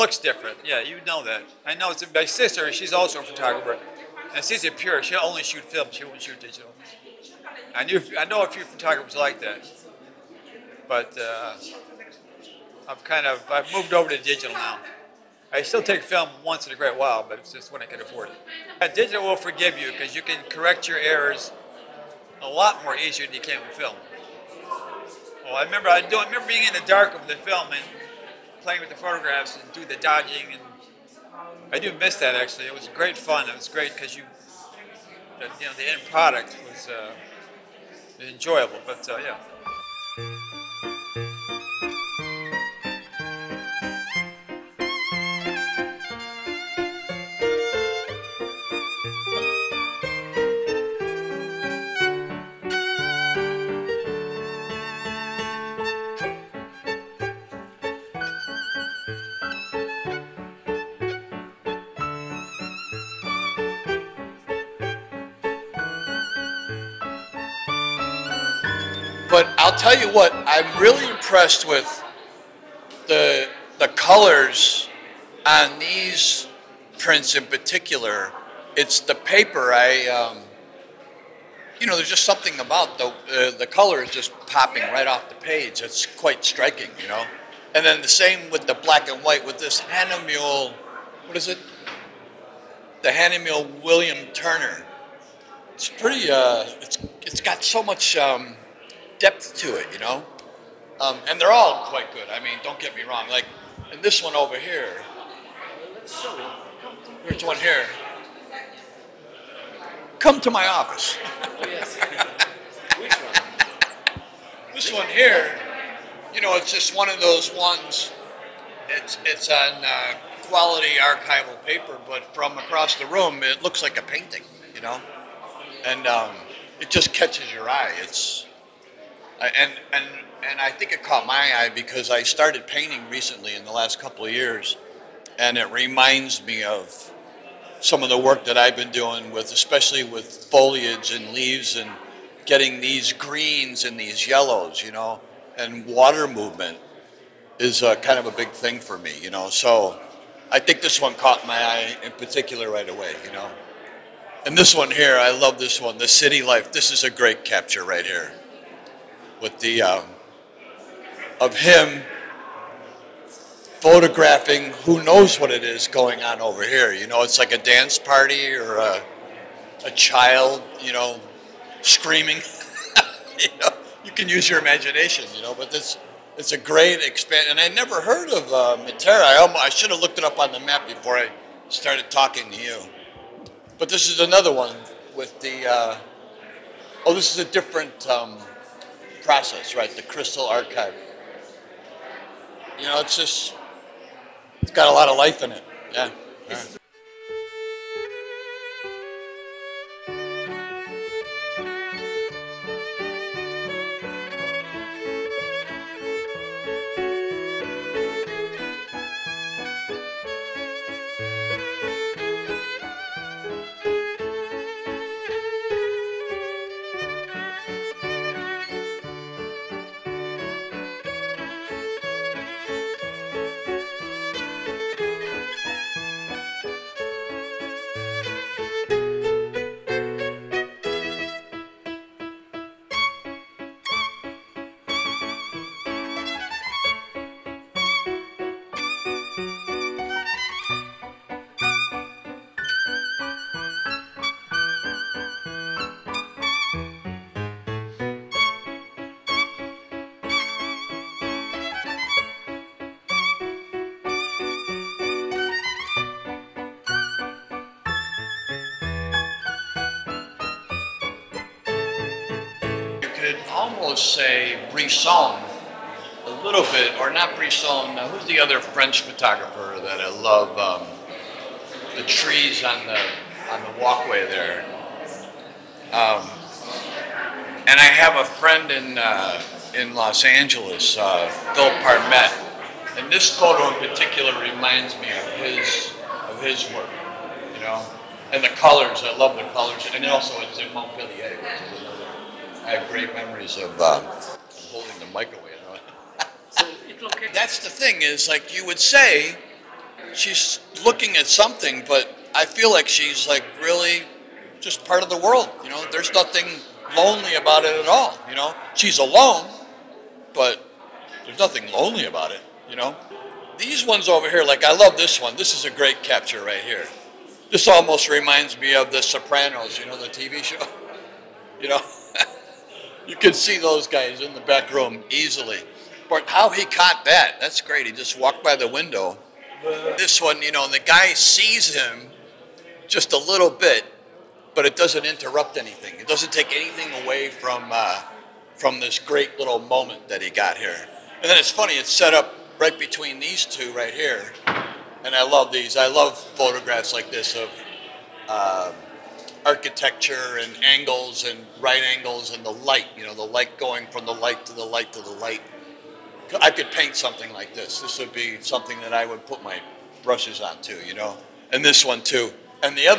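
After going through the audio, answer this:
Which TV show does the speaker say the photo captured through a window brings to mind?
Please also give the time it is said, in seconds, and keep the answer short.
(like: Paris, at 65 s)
The Sopranos, at 318 s.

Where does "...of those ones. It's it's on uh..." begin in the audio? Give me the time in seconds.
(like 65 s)
117 s.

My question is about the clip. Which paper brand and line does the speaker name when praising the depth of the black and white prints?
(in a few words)
Hahnemühle William Turner.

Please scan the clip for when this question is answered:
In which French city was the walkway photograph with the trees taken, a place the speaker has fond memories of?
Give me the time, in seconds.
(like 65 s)
290 s.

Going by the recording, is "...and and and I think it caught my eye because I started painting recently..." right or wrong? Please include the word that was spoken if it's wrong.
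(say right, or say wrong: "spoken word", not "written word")
right.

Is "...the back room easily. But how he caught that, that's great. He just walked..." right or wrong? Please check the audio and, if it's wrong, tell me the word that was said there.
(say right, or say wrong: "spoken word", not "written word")
right.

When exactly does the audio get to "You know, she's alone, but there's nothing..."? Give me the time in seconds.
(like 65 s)
308 s.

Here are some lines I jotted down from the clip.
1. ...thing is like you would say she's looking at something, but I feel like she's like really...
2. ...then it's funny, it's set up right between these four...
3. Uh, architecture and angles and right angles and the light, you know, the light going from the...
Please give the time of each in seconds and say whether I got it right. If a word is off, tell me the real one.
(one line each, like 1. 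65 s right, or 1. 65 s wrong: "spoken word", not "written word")
1. 297 s right
2. 341 s wrong: "two", not "four"
3. 348 s right.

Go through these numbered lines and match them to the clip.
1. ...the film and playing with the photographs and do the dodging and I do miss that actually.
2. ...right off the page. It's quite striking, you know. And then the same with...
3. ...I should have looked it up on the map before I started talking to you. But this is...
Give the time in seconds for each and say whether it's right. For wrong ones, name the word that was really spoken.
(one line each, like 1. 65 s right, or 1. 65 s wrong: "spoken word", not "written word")
1. 27 s right
2. 84 s right
3. 179 s right.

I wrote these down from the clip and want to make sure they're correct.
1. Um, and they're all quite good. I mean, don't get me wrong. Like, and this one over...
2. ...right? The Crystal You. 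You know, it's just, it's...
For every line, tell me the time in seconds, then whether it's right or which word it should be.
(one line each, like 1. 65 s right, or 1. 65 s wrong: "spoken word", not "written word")
1. 100 s right
2. 189 s wrong: "Archive", not "You".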